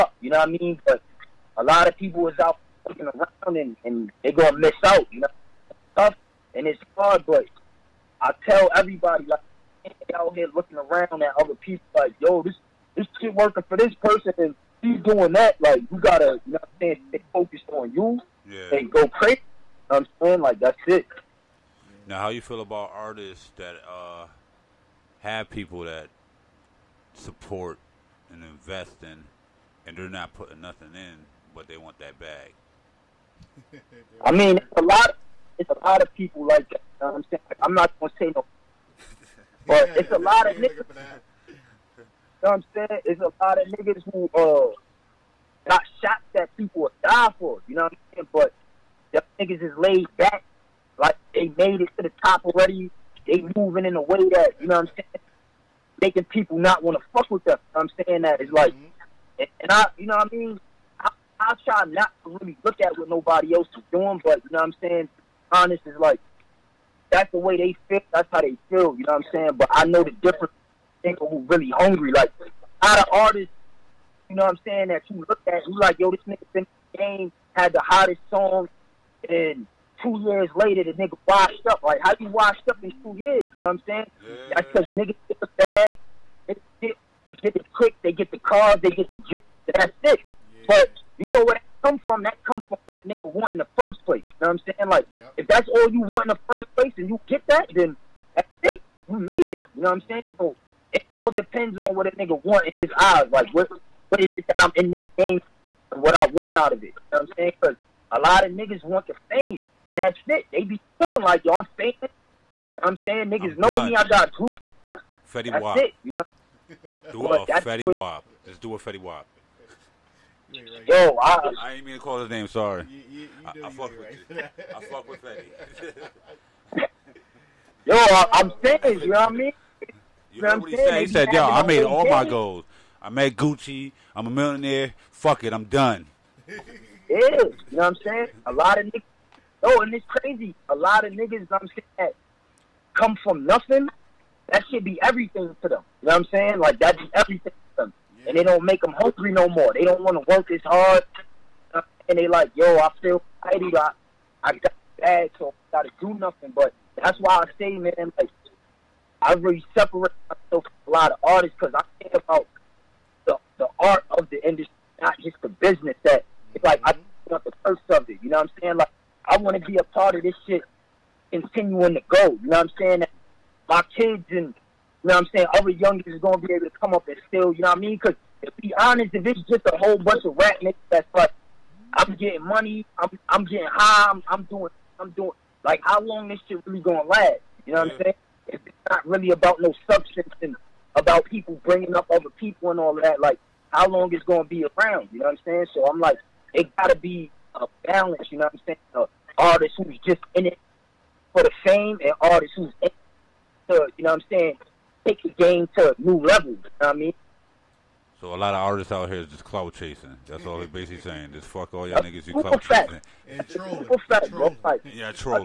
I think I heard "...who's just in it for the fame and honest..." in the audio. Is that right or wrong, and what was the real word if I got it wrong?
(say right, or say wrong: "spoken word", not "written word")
wrong: "artist", not "honest".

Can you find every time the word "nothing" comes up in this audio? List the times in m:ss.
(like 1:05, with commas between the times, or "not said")
0:30, 2:23, 2:36.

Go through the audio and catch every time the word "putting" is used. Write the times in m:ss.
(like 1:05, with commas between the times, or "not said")
0:30.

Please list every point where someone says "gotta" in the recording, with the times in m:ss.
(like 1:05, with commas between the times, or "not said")
0:15, 2:35.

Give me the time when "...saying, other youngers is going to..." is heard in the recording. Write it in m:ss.
2:55.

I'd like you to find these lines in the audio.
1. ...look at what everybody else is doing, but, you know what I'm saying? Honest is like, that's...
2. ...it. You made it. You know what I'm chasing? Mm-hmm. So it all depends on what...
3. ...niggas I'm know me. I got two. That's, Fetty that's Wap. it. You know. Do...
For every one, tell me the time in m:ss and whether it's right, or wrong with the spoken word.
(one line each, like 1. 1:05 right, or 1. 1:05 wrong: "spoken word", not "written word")
1. 1:02 wrong: "nobody", not "everybody"
2. 1:38 wrong: "saying", not "chasing"
3. 1:53 right.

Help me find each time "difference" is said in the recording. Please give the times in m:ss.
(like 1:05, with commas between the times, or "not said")
1:10.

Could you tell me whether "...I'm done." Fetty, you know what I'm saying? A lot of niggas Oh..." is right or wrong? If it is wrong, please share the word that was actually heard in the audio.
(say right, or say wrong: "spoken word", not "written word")
wrong: "Yeah", not "Fetty".